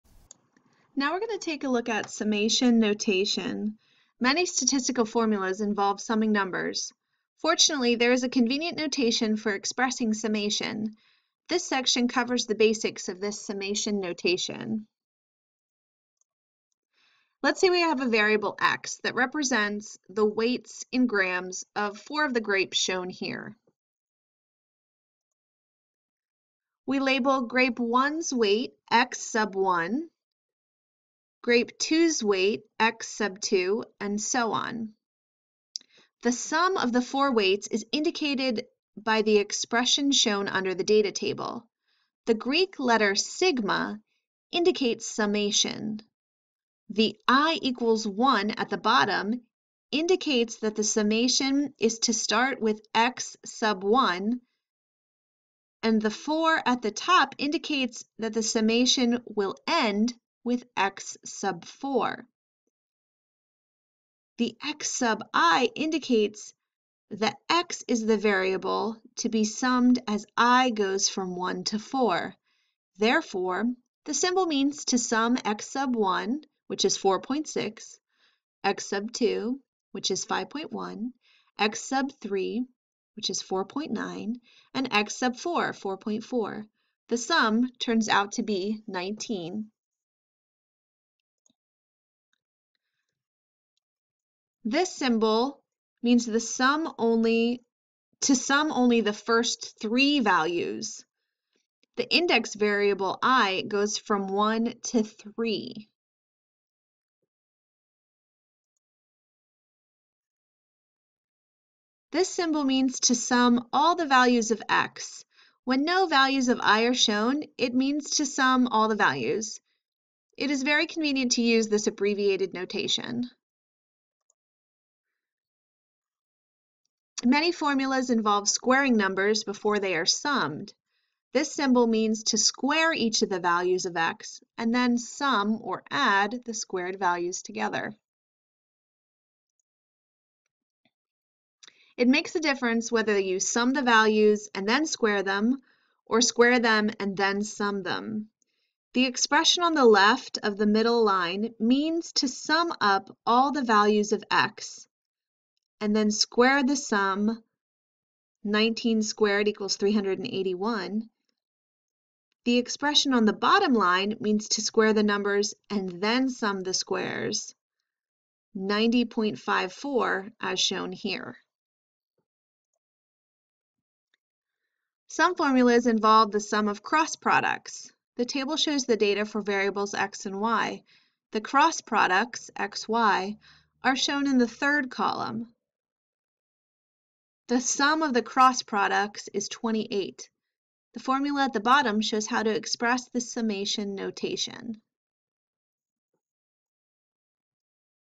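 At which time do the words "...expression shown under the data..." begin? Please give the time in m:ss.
0:39.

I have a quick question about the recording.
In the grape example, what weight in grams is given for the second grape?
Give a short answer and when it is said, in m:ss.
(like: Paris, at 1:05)
5.1, at 1:20.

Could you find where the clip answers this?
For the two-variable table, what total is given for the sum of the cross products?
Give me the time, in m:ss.
3:09.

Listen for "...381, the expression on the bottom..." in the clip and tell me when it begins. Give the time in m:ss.
2:39.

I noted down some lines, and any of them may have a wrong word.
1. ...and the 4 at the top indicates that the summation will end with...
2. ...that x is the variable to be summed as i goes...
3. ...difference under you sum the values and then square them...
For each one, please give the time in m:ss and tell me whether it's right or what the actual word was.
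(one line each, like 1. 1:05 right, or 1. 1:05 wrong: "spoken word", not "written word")
1. 0:55 right
2. 1:07 right
3. 2:22 wrong: "whether", not "under".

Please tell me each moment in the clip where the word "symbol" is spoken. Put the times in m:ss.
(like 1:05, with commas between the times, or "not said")
1:14, 1:34, 1:52, 2:11.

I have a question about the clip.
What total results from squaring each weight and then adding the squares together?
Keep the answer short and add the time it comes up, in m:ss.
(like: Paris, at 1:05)
90.54, at 2:48.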